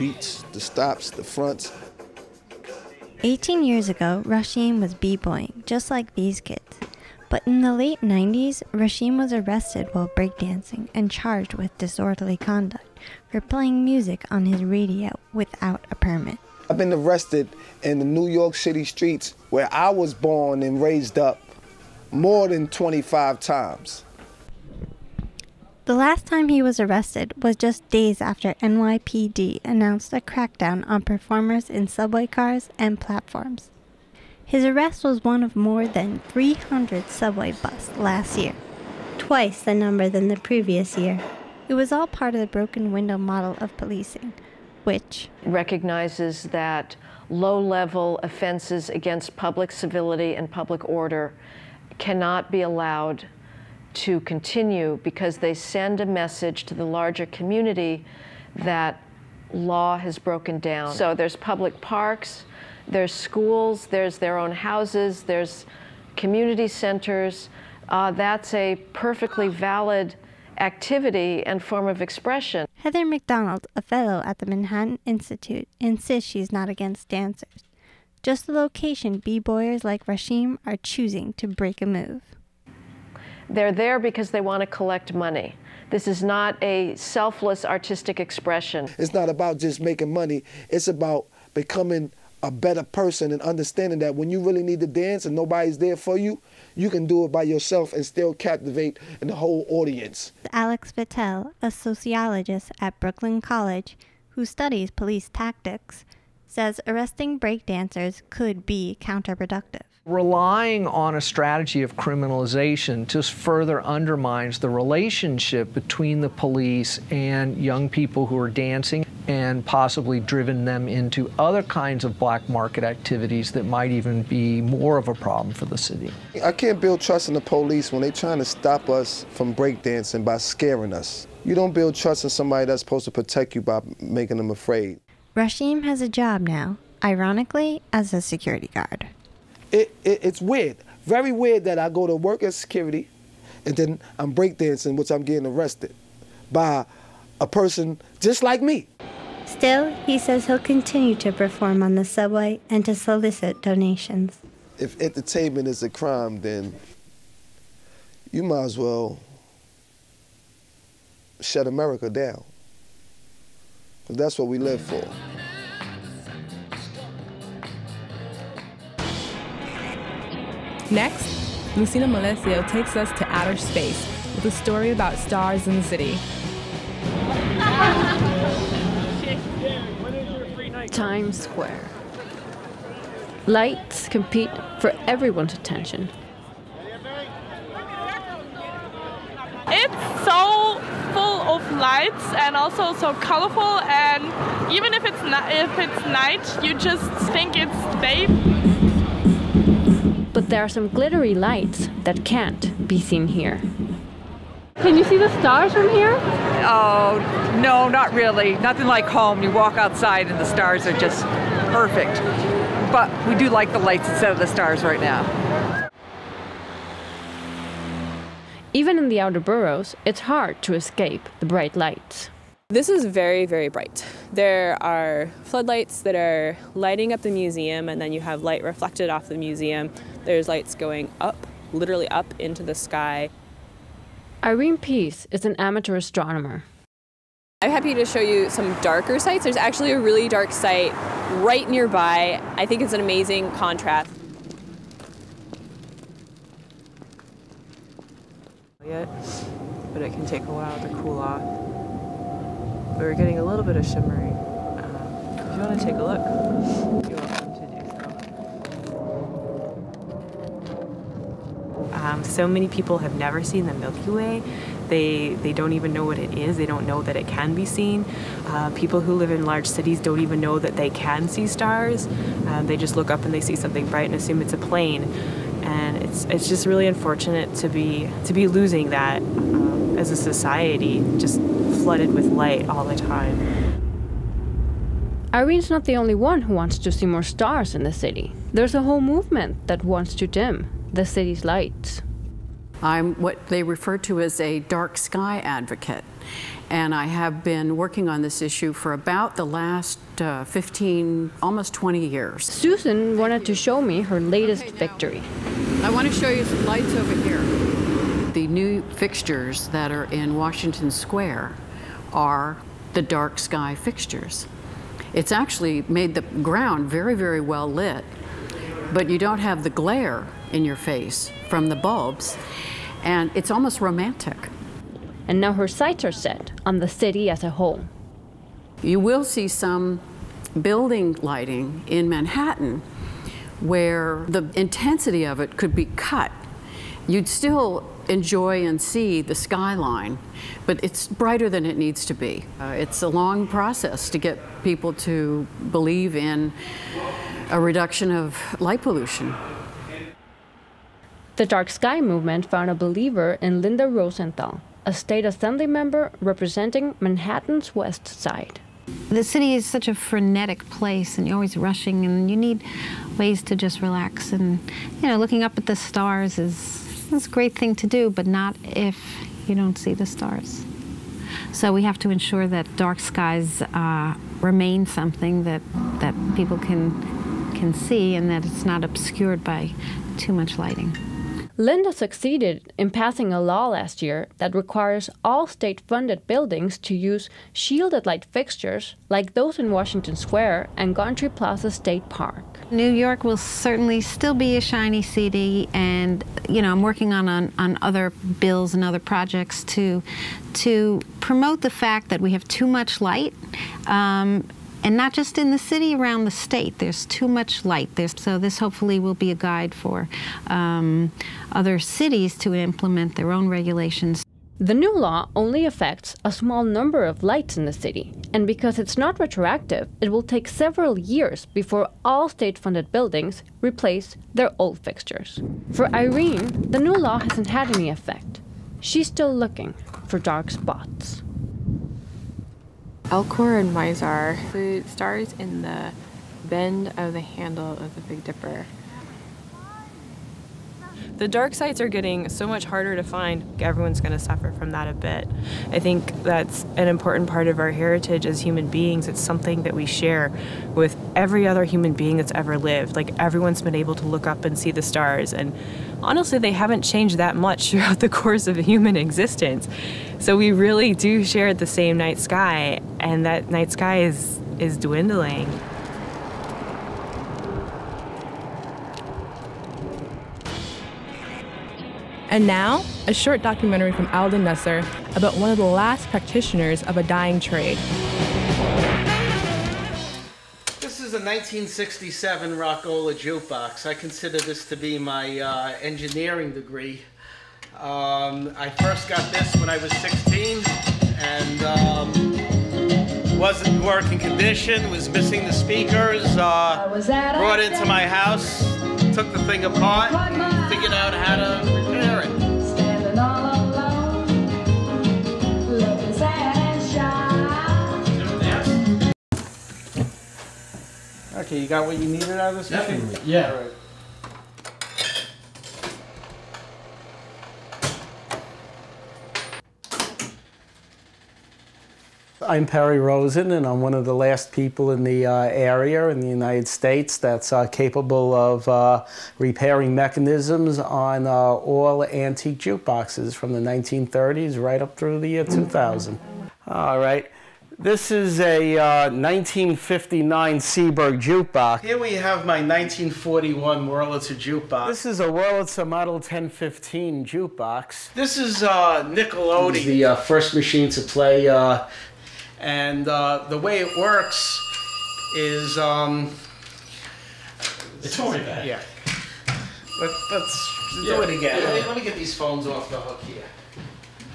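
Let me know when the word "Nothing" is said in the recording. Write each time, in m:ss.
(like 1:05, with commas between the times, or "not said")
3:28.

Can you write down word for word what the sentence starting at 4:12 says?
But we're getting a little bit of shimmering.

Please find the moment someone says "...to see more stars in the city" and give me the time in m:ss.
4:46.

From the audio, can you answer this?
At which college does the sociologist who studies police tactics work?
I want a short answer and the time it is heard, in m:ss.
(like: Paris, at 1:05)
Brooklyn College, at 1:42.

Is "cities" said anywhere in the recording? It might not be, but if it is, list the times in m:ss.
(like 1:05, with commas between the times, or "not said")
4:29, 6:51.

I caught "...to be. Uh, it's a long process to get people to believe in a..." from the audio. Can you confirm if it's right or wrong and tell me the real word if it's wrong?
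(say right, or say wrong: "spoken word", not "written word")
right.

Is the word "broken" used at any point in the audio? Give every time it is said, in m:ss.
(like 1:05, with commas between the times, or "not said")
0:42, 1:00.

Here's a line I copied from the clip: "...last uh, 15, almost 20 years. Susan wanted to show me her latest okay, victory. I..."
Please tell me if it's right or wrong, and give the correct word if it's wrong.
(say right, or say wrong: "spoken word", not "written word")
right.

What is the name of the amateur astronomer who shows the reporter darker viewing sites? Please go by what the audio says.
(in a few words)
Irene Peace.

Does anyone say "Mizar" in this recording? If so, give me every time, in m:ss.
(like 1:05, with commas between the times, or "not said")
7:13.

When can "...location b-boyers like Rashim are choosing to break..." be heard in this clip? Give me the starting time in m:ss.
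1:18.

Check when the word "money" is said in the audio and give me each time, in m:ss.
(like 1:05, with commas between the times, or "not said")
1:25, 1:30.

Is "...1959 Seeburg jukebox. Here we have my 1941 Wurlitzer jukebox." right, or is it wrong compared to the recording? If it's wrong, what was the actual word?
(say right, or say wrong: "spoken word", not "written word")
right.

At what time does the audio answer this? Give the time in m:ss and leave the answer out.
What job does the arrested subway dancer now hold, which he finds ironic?
2:18.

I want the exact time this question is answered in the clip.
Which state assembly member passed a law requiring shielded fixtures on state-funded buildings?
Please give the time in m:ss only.
5:53.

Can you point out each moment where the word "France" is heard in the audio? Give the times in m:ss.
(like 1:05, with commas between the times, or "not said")
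not said.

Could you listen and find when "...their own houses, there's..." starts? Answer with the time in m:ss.
1:04.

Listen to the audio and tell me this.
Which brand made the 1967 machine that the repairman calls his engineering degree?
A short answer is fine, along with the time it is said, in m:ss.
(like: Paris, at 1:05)
Rock-Ola, at 8:02.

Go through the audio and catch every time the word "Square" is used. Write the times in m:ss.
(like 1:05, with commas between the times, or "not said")
3:01, 5:10, 6:30.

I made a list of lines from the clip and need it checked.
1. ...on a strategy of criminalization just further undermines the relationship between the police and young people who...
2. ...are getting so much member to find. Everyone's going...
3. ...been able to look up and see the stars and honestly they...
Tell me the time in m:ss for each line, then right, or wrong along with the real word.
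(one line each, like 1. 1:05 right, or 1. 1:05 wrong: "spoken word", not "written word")
1. 1:50 right
2. 7:21 wrong: "harder", not "member"
3. 7:33 right.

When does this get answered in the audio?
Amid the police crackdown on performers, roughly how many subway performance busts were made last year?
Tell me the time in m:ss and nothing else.
0:35.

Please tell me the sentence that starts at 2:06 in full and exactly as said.
I can't build trust in the police when they're trying to stop us from breakdancing by scaring us.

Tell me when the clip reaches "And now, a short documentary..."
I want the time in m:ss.
7:52.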